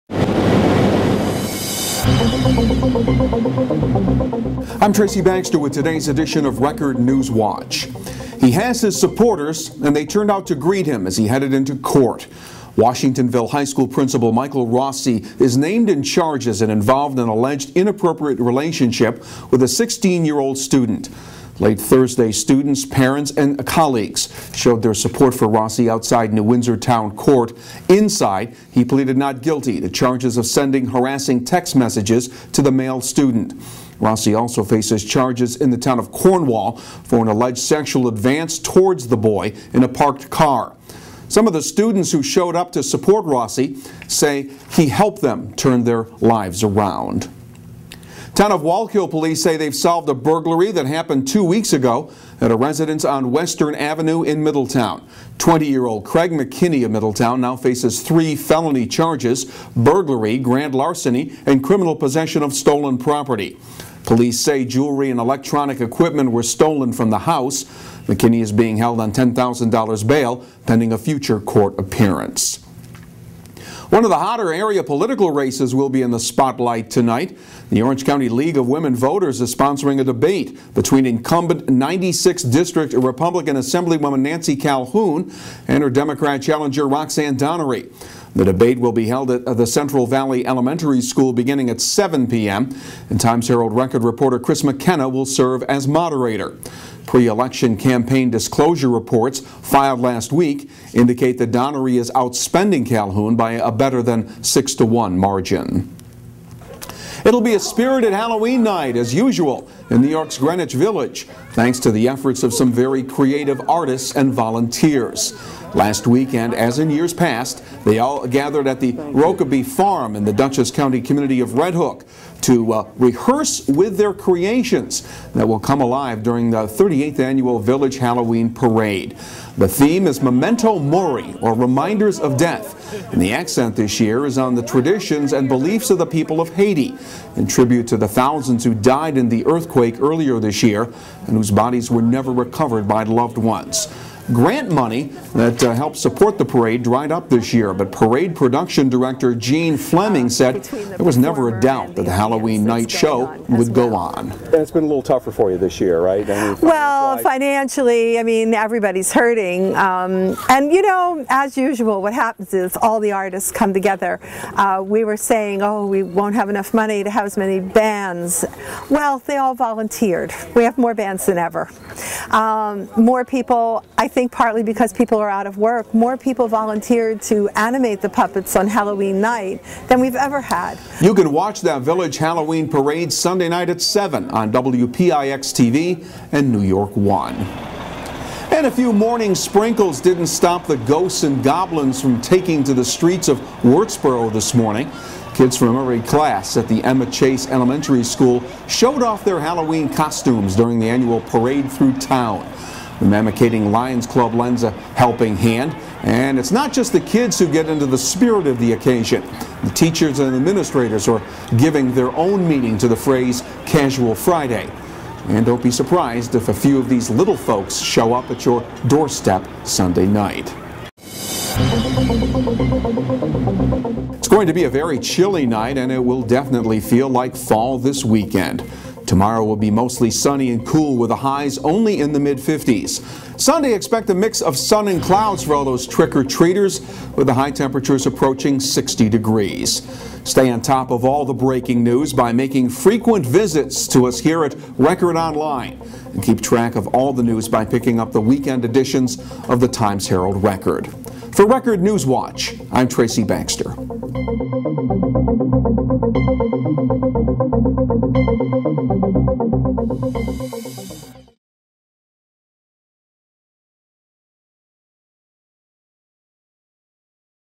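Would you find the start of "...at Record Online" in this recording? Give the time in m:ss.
4:04.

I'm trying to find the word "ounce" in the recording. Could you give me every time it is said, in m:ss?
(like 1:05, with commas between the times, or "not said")
not said.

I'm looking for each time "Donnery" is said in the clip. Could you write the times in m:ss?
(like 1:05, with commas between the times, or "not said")
1:27, 1:41.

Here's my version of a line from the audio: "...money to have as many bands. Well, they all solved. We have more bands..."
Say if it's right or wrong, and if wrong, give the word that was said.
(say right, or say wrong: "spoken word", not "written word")
wrong: "volunteered", not "solved".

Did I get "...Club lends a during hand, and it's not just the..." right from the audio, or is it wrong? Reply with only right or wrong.
wrong.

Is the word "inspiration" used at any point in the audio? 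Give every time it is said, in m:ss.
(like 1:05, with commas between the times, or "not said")
not said.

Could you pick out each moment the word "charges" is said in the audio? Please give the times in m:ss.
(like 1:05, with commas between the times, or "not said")
0:16, 0:29, 0:35, 0:58.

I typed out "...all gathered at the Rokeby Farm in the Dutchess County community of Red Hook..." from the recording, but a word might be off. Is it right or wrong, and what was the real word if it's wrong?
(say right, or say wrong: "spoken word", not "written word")
right.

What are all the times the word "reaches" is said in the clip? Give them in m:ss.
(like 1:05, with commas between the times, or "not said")
not said.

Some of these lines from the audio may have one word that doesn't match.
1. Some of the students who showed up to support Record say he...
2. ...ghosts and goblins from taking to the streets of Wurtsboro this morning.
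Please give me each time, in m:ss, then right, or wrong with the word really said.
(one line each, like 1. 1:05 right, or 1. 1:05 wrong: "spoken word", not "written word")
1. 0:41 wrong: "Rossi", not "Record"
2. 3:10 right.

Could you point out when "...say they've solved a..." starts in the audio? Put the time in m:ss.
0:49.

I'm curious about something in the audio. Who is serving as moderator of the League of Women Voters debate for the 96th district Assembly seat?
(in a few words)
Chris McKenna.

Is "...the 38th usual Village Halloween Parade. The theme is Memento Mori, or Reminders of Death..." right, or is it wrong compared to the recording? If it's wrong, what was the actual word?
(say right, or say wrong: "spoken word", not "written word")
wrong: "annual", not "usual".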